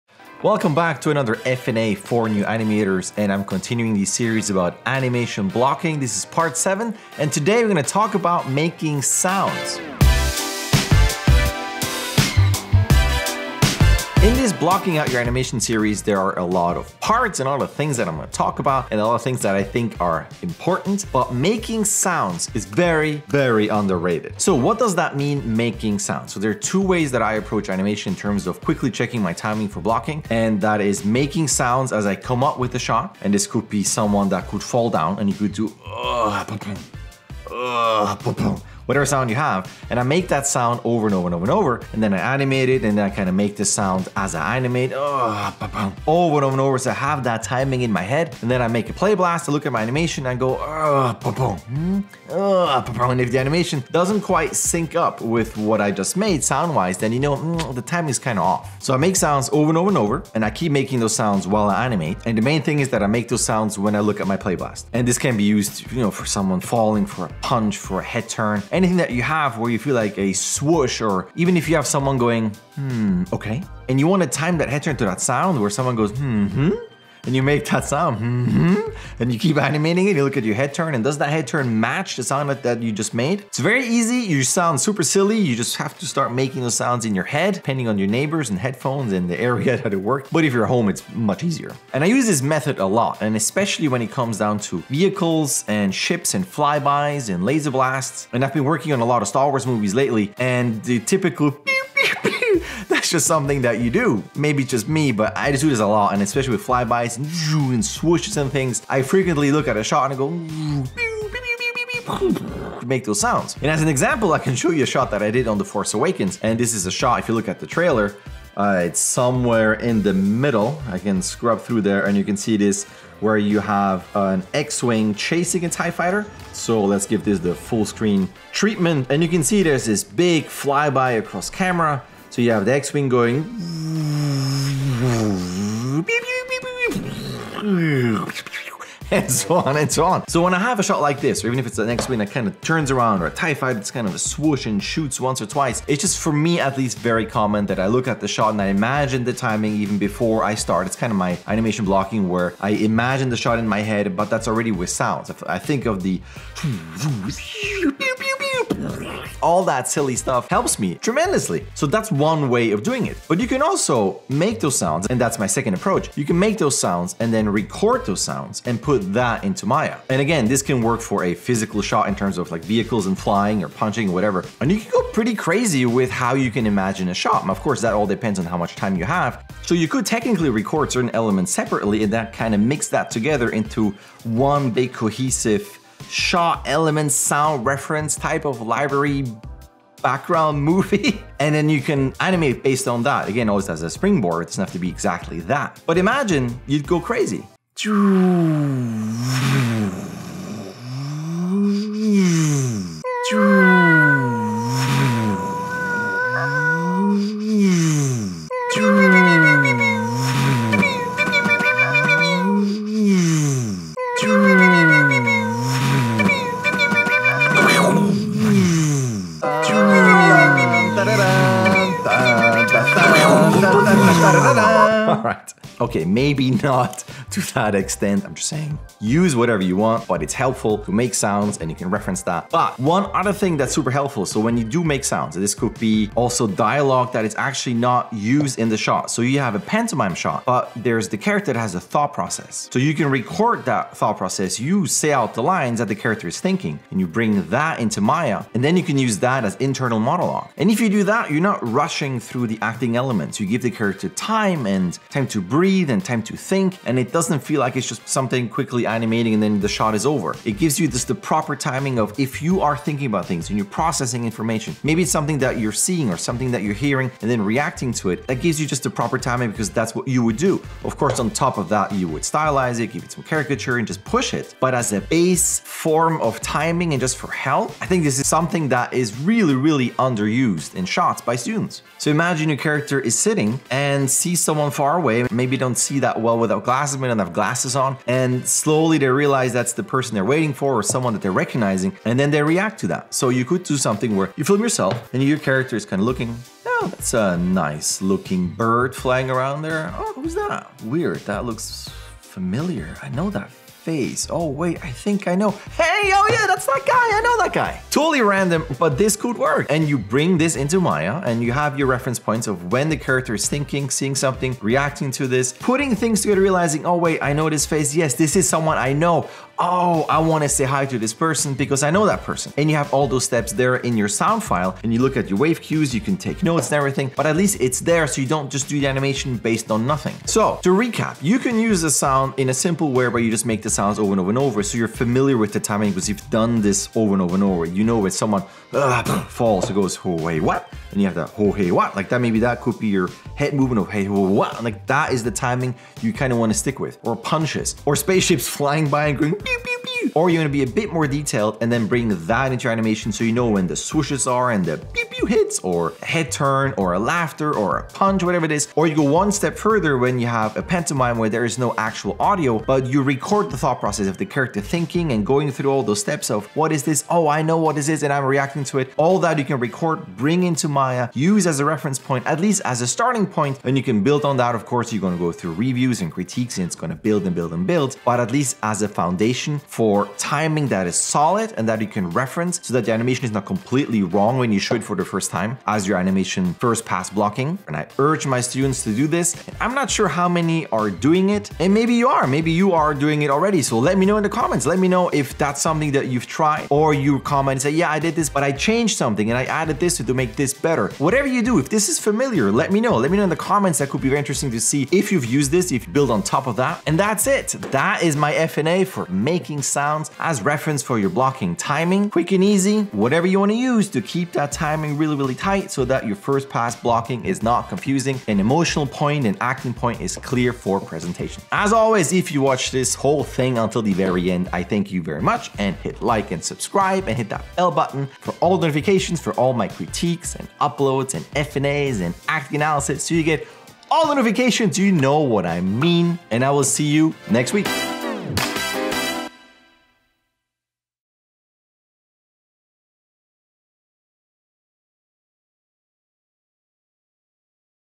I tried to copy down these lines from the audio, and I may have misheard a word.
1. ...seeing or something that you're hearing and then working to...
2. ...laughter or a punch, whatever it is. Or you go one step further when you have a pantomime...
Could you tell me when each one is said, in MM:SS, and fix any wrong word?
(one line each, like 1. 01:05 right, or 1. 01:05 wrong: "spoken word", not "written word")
1. 04:25 wrong: "reacting", not "working"
2. 05:56 right.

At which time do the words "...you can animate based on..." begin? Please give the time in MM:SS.
03:11.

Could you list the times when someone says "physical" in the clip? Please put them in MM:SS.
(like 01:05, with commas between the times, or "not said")
02:51.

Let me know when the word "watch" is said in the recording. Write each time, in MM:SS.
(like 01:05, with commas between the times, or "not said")
07:02.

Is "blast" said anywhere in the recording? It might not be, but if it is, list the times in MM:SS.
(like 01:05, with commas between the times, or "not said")
00:49, 01:04, 01:37.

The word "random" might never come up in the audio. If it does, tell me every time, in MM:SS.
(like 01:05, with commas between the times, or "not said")
05:08.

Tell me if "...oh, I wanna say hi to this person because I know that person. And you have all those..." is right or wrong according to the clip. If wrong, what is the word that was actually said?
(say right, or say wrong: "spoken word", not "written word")
right.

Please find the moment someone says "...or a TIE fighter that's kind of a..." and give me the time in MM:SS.
02:23.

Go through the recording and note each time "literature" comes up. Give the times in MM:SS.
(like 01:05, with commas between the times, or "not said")
not said.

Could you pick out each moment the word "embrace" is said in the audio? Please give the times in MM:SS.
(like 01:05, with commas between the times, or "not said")
not said.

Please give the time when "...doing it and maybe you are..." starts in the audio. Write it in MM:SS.
06:30.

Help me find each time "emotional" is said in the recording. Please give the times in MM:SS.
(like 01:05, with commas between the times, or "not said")
06:58.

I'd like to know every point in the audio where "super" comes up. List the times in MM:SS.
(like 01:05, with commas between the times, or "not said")
01:24, 03:53.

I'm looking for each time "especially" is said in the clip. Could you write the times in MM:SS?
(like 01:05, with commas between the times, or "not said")
01:33, 01:46.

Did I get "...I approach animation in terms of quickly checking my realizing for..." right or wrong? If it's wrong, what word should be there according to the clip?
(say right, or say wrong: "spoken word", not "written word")
wrong: "timing", not "realizing".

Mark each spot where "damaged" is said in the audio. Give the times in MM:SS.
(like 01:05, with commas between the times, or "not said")
not said.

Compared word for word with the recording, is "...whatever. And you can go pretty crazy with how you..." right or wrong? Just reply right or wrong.
right.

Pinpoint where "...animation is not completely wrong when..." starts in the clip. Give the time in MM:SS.
06:22.